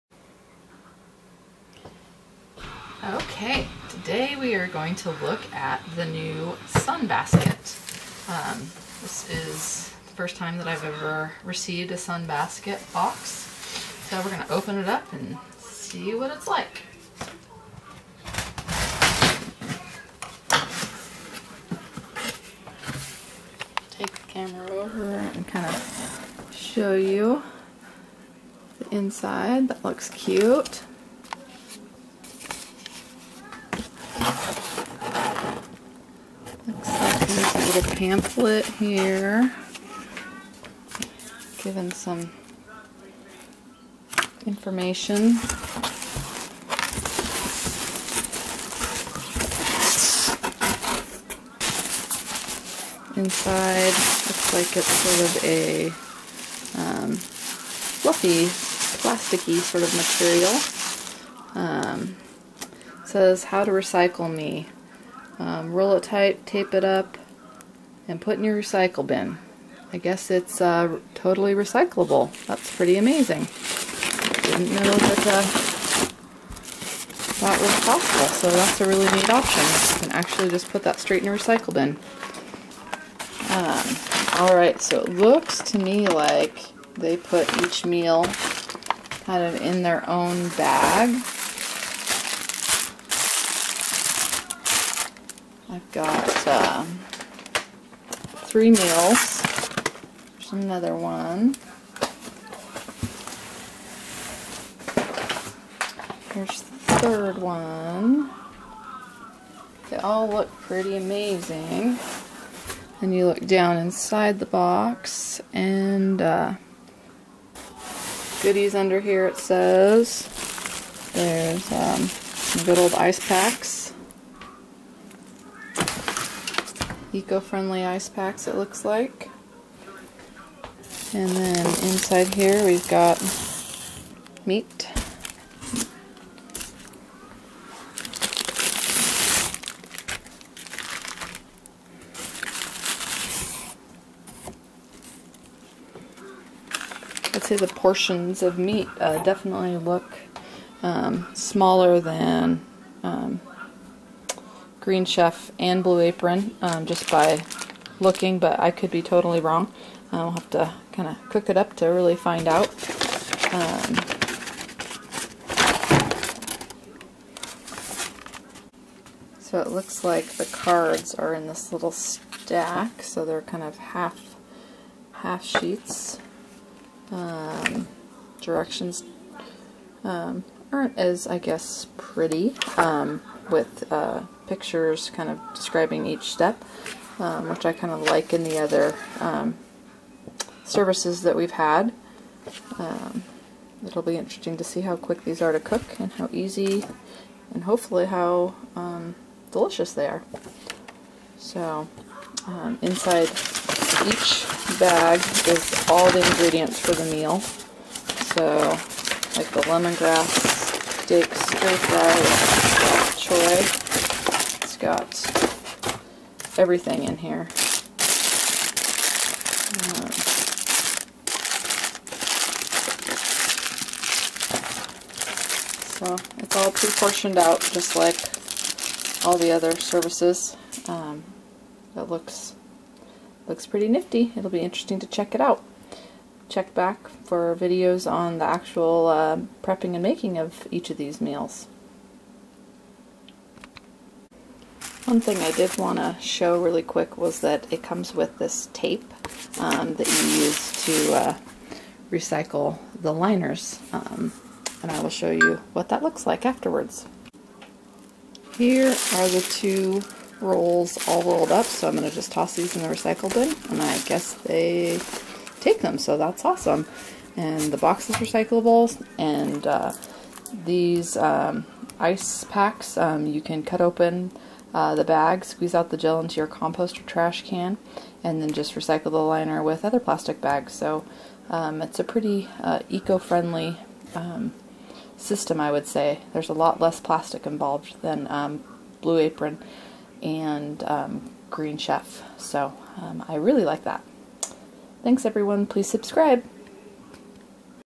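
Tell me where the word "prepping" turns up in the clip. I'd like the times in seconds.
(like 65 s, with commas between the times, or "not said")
239 s.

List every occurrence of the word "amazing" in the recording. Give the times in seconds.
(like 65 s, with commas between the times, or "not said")
72 s, 110 s.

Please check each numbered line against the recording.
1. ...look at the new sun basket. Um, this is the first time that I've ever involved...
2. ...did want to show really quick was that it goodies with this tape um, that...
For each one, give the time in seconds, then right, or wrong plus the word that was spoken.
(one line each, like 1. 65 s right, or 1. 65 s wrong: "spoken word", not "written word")
1. 5 s wrong: "received", not "involved"
2. 245 s wrong: "comes", not "goodies".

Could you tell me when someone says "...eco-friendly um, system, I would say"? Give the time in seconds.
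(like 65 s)
282 s.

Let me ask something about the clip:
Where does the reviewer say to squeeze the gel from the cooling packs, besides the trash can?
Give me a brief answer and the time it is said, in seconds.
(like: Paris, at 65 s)
Compost, at 276 s.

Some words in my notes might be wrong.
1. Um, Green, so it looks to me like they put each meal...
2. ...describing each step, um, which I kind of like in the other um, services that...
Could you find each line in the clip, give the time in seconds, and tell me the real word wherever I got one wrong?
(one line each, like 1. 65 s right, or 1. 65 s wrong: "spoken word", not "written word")
1. 83 s wrong: "Alright", not "Green"
2. 185 s right.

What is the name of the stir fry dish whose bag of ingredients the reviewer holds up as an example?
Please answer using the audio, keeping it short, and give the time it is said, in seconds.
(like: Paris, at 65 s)
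Lemongrass dips stir fry choy, at 209 s.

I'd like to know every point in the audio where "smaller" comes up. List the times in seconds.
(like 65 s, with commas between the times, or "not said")
151 s.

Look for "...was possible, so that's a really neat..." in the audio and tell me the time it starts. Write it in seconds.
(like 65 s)
77 s.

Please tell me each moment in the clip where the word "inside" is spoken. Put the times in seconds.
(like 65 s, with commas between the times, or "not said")
28 s, 53 s, 113 s, 131 s, 202 s.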